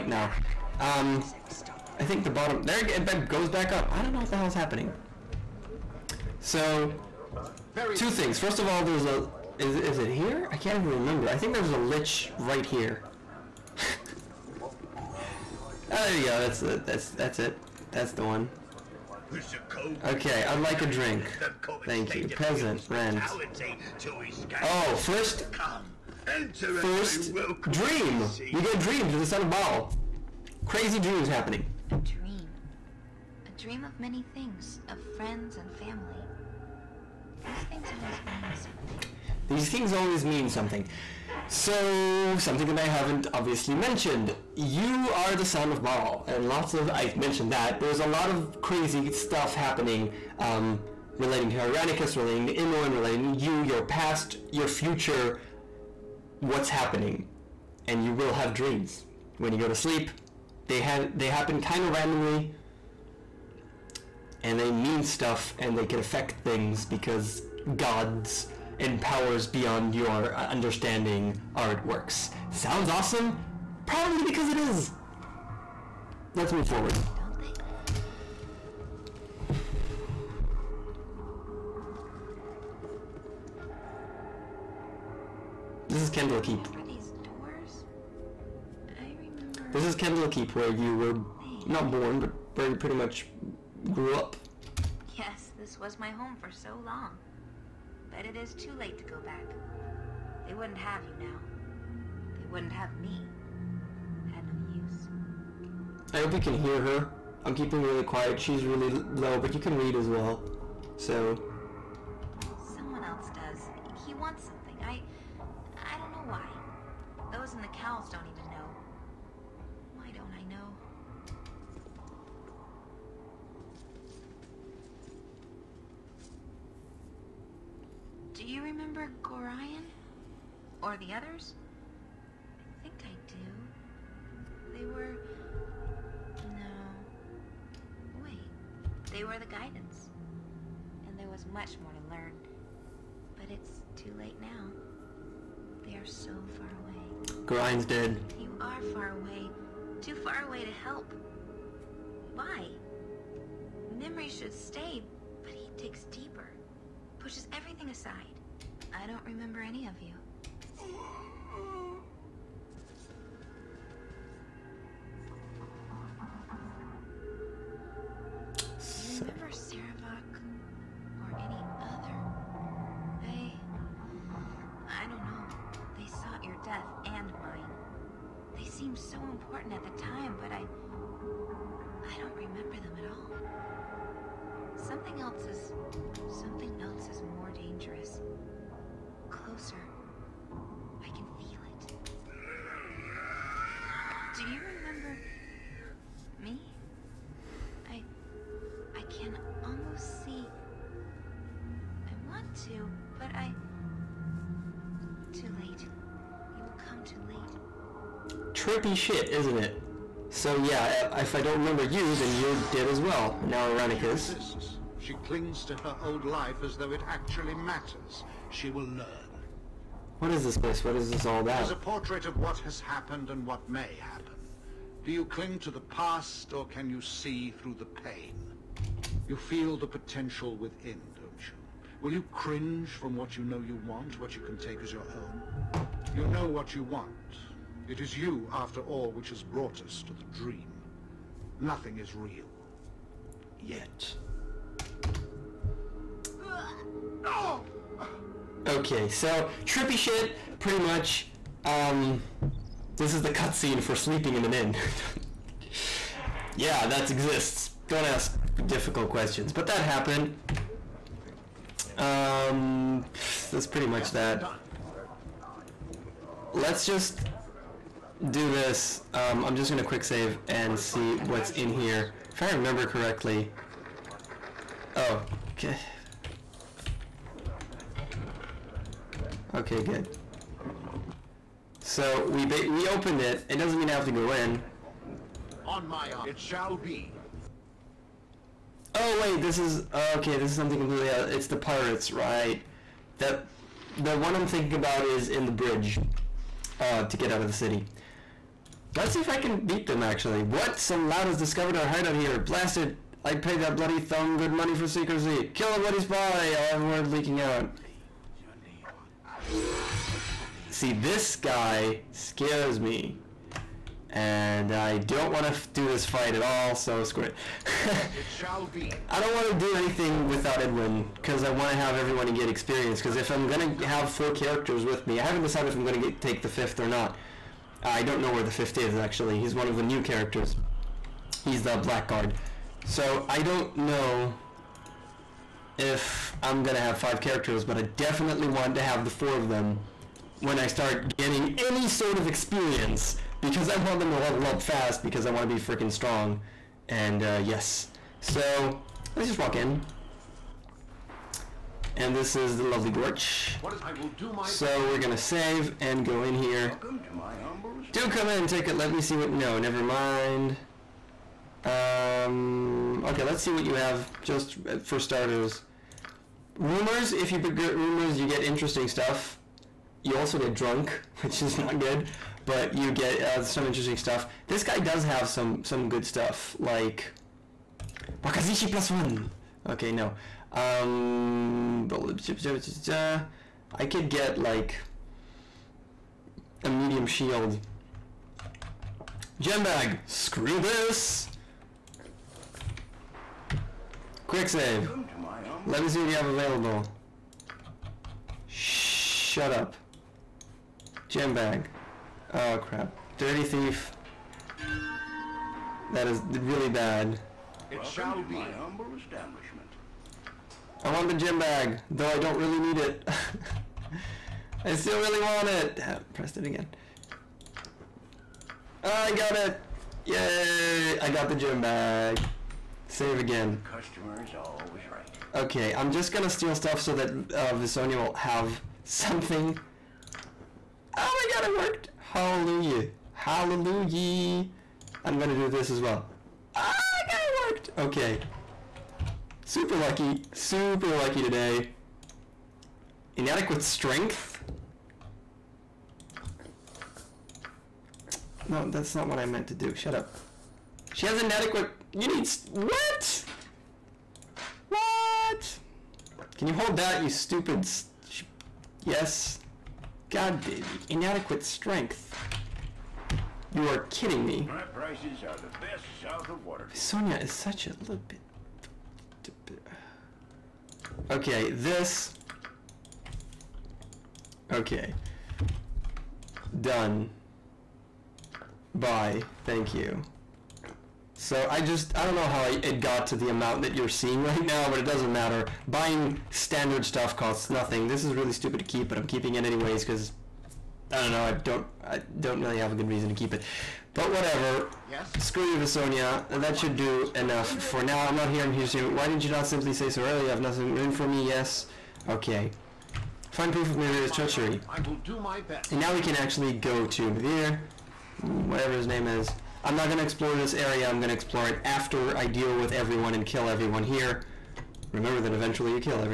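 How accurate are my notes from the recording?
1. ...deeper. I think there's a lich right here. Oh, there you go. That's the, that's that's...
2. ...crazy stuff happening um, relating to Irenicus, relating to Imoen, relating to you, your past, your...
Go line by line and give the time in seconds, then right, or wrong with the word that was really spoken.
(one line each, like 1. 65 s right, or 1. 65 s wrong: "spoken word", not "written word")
1. 10 s wrong: "remember", not "deeper"
2. 48 s right.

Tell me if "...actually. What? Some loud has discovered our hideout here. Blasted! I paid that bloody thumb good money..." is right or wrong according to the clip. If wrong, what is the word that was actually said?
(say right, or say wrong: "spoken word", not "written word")
right.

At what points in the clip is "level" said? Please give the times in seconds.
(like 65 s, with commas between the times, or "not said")
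344 s.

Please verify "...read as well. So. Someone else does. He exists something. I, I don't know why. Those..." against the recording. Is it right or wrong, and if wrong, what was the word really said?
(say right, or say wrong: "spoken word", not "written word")
wrong: "wants", not "exists".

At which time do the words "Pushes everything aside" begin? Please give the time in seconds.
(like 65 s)
157 s.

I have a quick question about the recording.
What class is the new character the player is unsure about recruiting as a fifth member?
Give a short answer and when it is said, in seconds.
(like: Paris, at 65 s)
Blackguard, at 331 s.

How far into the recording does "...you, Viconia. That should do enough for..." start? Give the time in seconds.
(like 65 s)
495 s.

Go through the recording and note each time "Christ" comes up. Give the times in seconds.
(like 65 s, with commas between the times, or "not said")
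not said.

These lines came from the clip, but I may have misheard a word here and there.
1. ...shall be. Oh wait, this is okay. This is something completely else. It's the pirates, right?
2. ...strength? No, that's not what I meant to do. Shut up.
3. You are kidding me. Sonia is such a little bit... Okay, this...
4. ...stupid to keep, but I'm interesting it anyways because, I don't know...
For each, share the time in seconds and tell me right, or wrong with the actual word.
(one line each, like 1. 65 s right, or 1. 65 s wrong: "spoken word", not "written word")
1. 286 s right
2. 443 s right
3. 463 s right
4. 488 s wrong: "keeping", not "interesting".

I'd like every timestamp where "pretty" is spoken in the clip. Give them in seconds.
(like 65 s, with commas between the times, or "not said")
92 s, 250 s, 263 s.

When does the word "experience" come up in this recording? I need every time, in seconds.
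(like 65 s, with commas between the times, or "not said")
322 s, 342 s.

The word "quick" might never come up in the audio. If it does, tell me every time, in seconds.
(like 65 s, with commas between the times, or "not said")
269 s, 394 s.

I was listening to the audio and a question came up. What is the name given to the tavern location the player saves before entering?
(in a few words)
Gorch.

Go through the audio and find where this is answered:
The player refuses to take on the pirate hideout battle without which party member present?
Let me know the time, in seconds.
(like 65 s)
320 s.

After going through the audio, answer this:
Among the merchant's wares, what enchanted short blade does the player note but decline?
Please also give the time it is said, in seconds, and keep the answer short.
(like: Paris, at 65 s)
Wakizashi plus one, at 378 s.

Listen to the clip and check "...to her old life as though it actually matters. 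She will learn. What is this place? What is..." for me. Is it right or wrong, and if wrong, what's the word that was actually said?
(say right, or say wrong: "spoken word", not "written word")
right.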